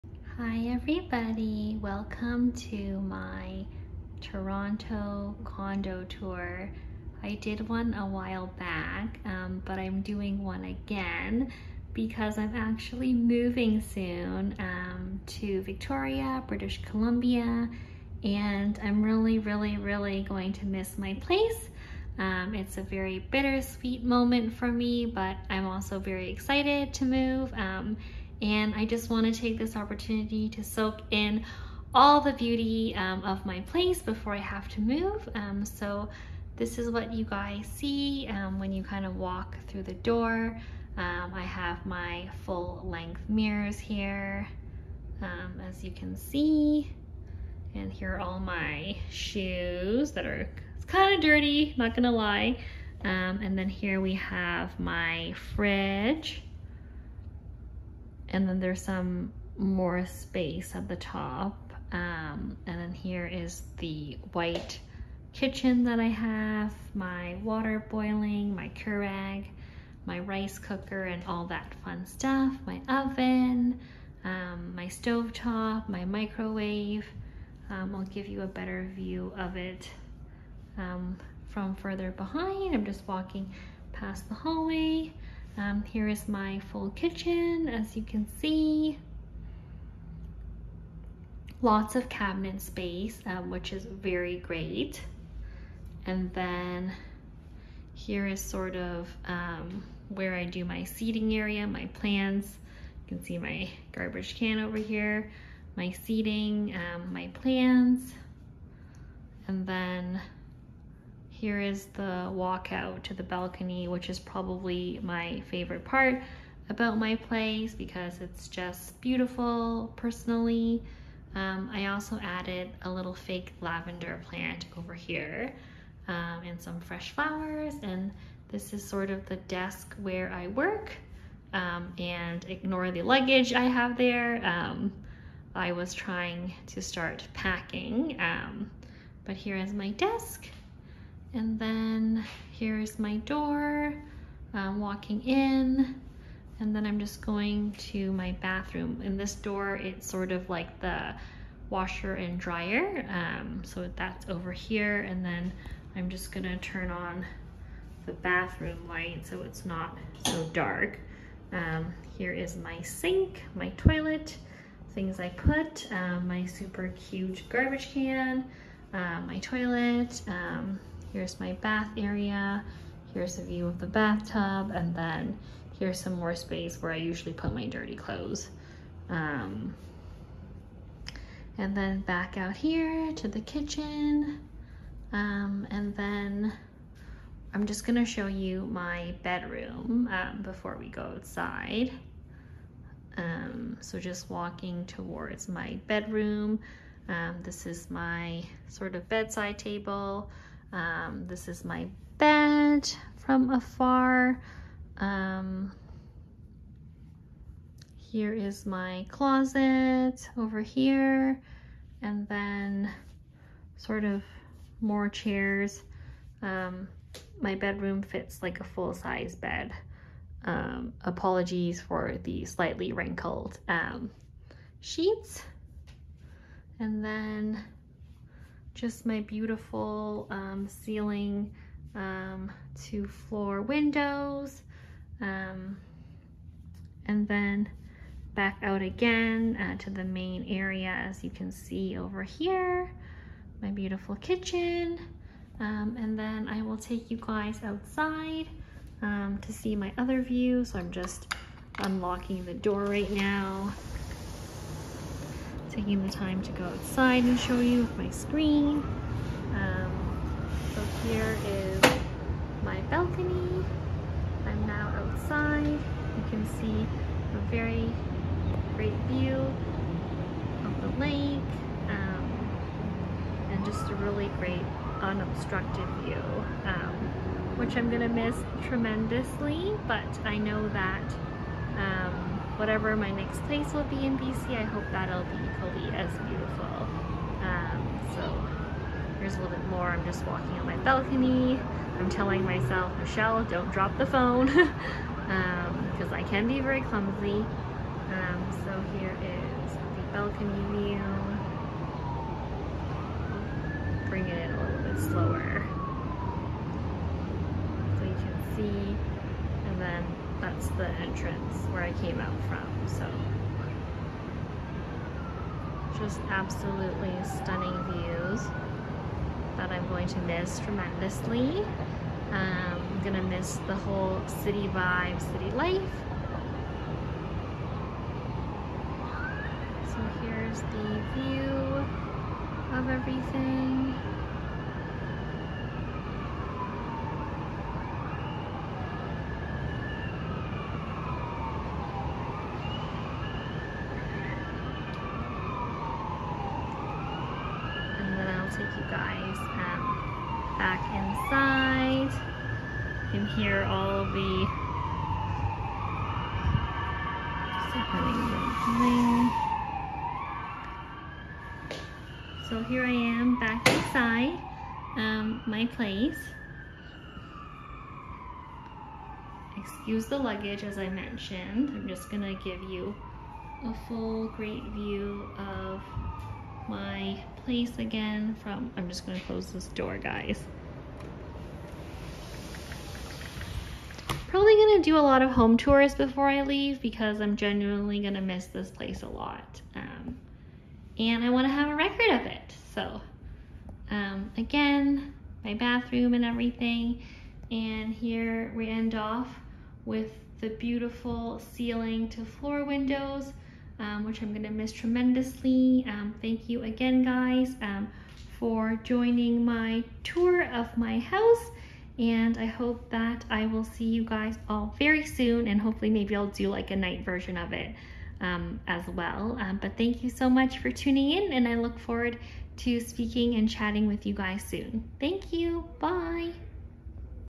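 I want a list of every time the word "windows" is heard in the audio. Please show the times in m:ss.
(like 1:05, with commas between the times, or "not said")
3:53, 6:42.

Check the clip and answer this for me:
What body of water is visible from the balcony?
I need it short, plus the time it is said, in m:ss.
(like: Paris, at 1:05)
The lake, at 4:30.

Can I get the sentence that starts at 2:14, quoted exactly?
Um, I was trying to start packing, um, but here is my desk.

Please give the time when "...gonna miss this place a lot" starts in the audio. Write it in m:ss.
6:27.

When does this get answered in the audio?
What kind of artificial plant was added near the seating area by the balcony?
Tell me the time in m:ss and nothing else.
2:03.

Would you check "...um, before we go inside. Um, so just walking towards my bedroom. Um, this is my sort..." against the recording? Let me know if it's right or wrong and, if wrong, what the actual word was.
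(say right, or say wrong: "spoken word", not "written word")
wrong: "outside", not "inside".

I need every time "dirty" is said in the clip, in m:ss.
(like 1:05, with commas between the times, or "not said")
0:51, 2:57.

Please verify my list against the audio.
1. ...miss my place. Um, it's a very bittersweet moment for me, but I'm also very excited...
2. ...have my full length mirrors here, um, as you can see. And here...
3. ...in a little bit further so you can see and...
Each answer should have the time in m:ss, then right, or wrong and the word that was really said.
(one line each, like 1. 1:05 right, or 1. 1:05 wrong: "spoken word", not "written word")
1. 0:20 right
2. 0:41 right
3. 5:04 wrong: "slower", not "further".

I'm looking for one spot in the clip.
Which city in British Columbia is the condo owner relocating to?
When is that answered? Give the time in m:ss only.
0:15.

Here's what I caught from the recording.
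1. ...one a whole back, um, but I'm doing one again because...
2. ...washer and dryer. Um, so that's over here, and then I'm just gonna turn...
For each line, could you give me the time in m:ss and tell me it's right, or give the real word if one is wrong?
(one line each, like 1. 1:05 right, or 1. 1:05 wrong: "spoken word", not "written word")
1. 0:07 wrong: "while", not "whole"
2. 2:31 right.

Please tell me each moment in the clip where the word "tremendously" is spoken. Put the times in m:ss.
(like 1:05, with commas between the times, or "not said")
4:38, 5:20, 6:44.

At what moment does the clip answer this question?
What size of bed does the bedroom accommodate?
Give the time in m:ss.
3:38.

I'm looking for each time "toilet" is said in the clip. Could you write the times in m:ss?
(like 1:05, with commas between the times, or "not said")
2:43, 2:49.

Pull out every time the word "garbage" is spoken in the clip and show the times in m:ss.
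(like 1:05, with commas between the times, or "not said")
1:43, 2:47.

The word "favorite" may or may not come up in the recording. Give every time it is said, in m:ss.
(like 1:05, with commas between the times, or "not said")
1:55.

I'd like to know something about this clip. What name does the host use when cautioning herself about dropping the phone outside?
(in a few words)
Michelle.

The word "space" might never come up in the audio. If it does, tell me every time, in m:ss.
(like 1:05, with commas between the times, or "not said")
1:00, 1:32, 2:56.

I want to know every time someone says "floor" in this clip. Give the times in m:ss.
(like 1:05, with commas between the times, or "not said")
3:53, 6:42.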